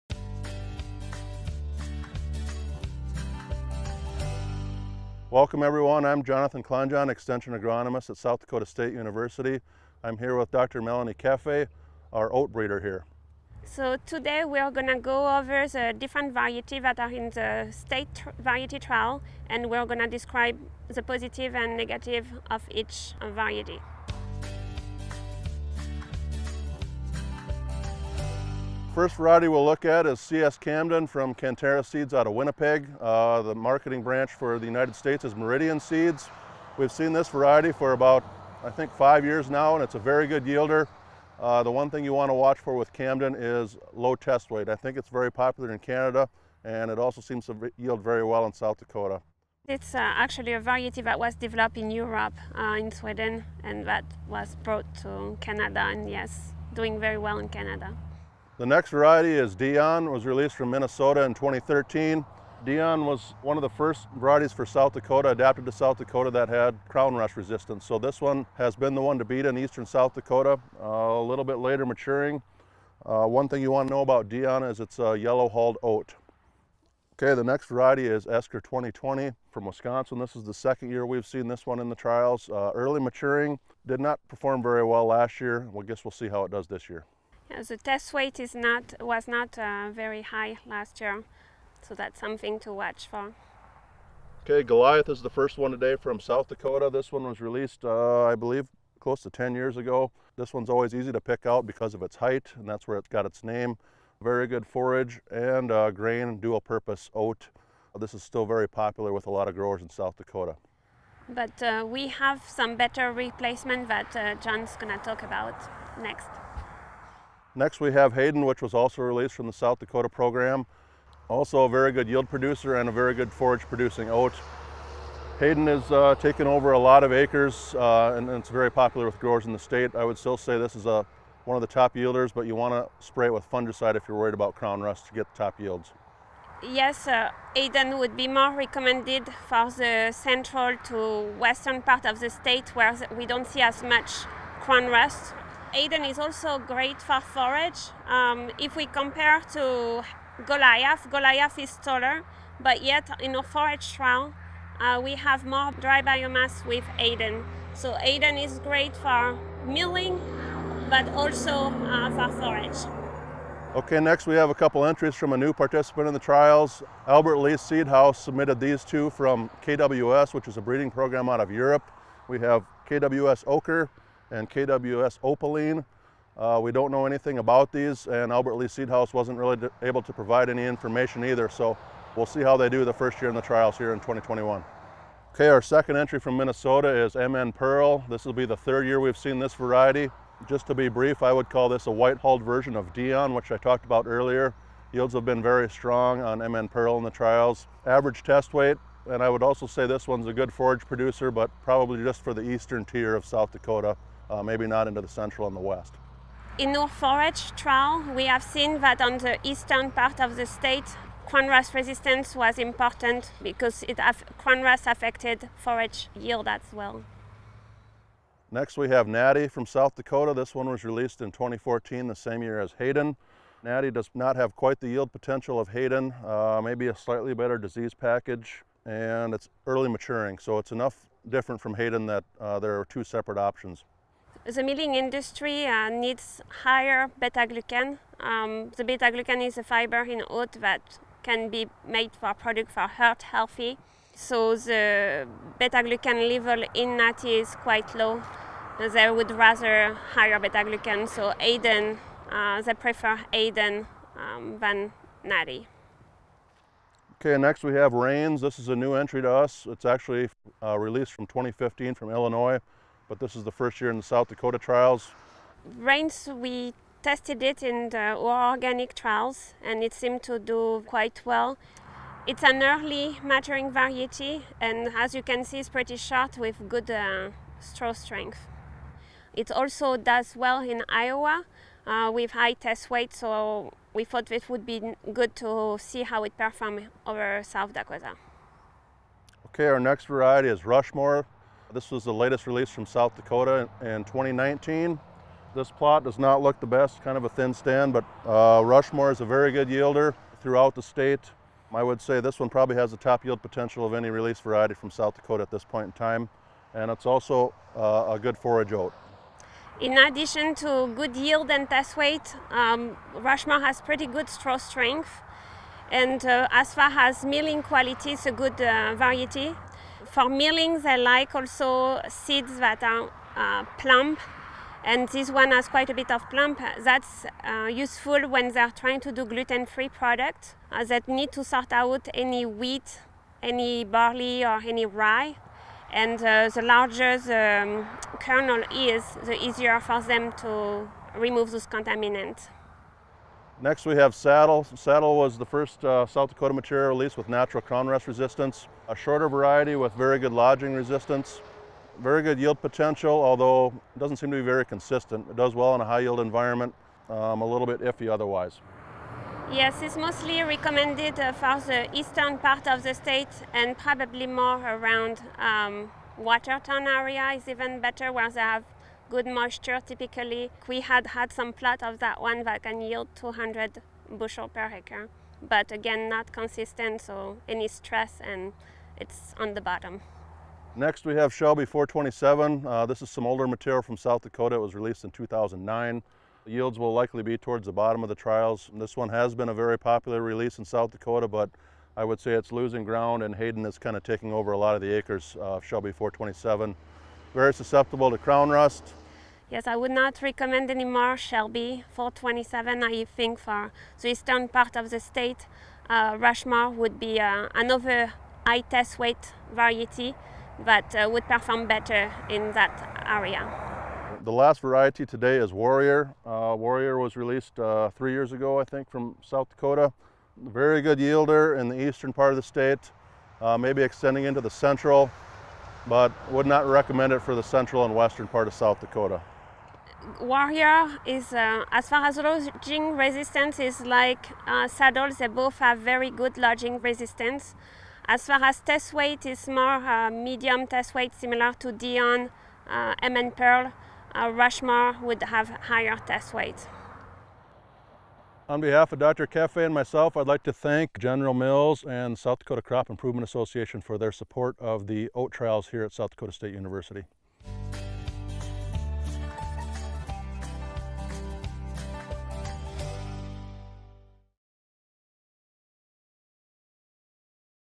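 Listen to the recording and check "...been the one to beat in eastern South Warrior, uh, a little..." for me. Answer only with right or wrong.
wrong.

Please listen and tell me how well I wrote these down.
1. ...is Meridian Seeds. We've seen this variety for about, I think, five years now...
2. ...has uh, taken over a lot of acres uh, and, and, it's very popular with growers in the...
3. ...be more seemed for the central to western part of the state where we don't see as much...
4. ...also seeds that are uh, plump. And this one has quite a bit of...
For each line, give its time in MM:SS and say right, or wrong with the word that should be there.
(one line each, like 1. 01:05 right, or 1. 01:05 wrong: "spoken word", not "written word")
1. 00:35 right
2. 02:05 right
3. 02:18 wrong: "recommended", not "seemed"
4. 05:21 right.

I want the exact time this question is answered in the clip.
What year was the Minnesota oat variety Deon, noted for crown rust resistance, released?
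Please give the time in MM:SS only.
01:01.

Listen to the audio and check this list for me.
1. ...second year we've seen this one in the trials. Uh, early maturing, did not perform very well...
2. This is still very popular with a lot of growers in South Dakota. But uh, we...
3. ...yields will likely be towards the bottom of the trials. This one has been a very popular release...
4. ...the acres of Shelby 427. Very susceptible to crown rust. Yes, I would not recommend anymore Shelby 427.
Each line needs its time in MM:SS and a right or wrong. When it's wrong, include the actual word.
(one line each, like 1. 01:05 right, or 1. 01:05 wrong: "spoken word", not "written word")
1. 01:20 right
2. 01:47 right
3. 06:26 right
4. 06:34 right.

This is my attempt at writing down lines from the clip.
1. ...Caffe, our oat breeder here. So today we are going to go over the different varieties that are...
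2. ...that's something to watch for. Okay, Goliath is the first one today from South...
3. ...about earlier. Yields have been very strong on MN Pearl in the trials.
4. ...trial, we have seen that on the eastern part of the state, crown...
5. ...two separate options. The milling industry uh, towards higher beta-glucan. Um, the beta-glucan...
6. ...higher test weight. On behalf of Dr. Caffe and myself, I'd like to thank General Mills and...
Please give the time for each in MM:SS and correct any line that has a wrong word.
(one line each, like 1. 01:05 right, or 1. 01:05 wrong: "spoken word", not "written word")
1. 00:11 right
2. 01:31 right
3. 03:13 right
4. 03:27 right
5. 03:52 wrong: "needs", not "towards"
6. 07:25 right.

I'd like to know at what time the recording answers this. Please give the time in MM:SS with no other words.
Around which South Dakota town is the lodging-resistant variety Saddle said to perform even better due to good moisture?
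06:06.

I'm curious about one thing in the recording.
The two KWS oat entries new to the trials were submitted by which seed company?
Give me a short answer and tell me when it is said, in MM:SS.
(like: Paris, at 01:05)
Albert Lea Seedhouse, at 02:47.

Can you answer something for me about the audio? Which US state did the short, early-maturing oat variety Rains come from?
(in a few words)
Illinois.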